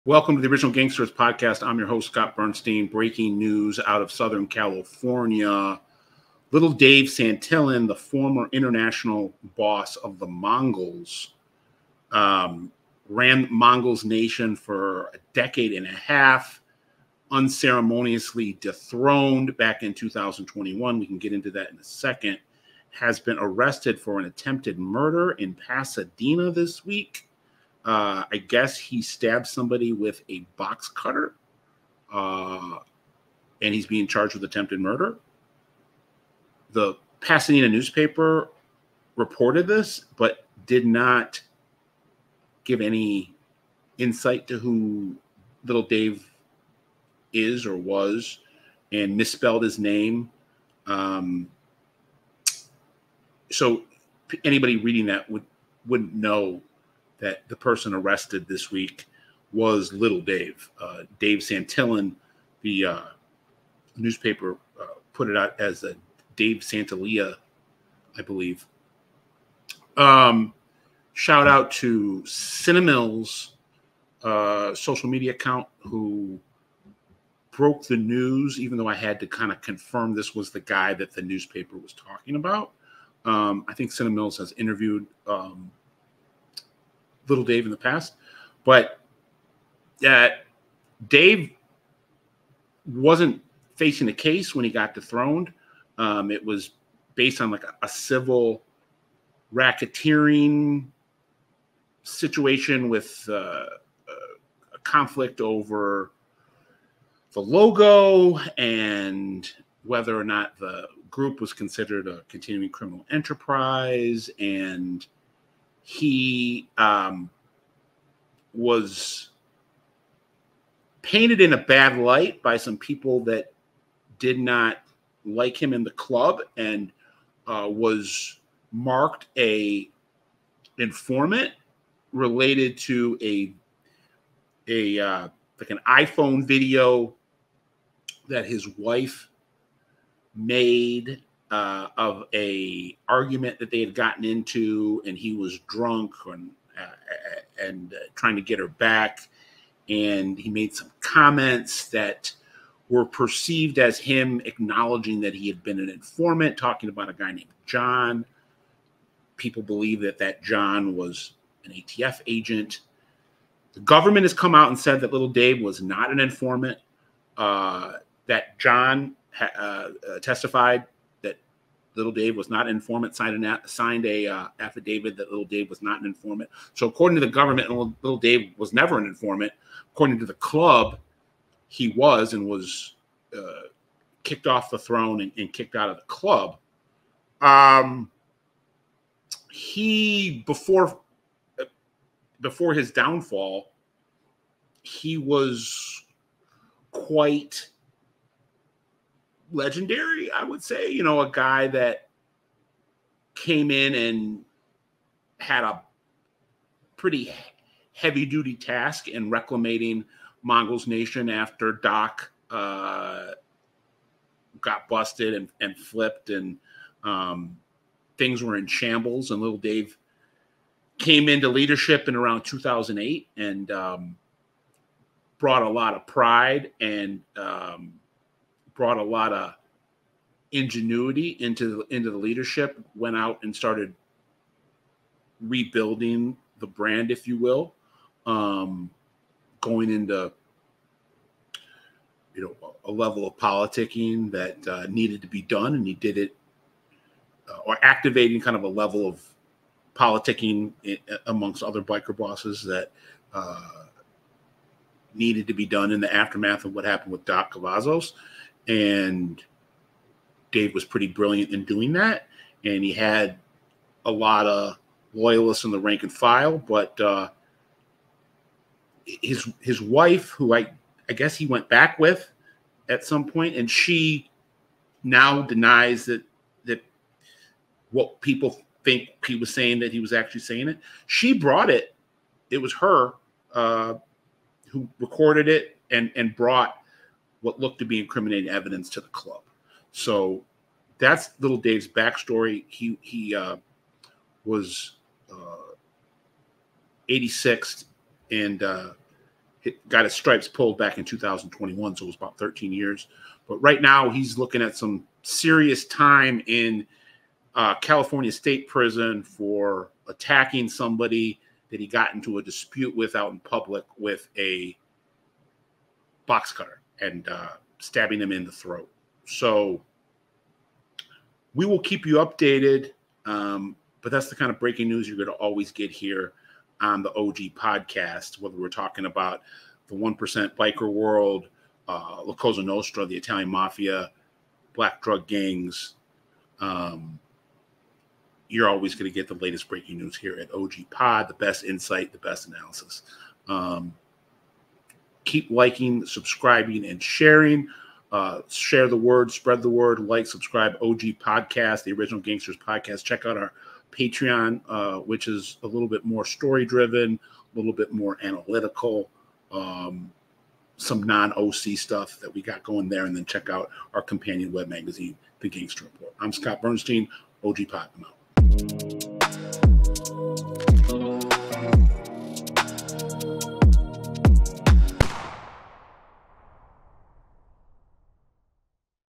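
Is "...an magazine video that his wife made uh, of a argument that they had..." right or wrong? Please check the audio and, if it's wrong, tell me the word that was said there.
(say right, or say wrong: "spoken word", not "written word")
wrong: "iPhone", not "magazine".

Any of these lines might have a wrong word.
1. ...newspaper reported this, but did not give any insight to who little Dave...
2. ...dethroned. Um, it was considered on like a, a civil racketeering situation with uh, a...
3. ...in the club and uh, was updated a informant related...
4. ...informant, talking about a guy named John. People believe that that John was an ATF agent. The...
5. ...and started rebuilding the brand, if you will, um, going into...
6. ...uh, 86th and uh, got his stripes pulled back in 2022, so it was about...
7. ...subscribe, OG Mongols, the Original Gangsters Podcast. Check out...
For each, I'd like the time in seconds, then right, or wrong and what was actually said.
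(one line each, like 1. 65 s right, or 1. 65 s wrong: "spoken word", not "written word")
1. 37 s right
2. 94 s wrong: "based", not "considered"
3. 125 s wrong: "marked", not "updated"
4. 155 s right
5. 233 s right
6. 295 s wrong: "2021", not "2022"
7. 350 s wrong: "Podcast", not "Mongols".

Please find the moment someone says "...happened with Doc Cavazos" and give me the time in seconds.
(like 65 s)
256 s.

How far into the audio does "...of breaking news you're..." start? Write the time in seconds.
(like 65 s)
324 s.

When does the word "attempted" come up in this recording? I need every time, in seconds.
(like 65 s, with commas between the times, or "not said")
24 s, 34 s.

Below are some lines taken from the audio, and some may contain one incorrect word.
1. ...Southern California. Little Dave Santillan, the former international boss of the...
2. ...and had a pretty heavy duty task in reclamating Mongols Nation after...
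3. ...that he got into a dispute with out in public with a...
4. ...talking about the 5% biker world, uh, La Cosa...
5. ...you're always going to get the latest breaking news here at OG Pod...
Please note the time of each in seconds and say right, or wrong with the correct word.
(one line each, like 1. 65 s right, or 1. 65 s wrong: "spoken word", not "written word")
1. 4 s right
2. 203 s right
3. 311 s right
4. 328 s wrong: "1", not "5"
5. 338 s right.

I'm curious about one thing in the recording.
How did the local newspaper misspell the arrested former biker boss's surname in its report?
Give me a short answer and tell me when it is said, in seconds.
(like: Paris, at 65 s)
Santalia, at 66 s.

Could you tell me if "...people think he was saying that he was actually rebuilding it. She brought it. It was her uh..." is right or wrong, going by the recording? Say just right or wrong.
wrong.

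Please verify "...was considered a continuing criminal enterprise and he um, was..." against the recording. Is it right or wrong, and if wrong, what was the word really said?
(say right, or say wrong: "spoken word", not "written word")
right.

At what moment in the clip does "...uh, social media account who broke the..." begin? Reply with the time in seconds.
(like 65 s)
74 s.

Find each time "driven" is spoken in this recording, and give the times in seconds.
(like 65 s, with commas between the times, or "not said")
356 s.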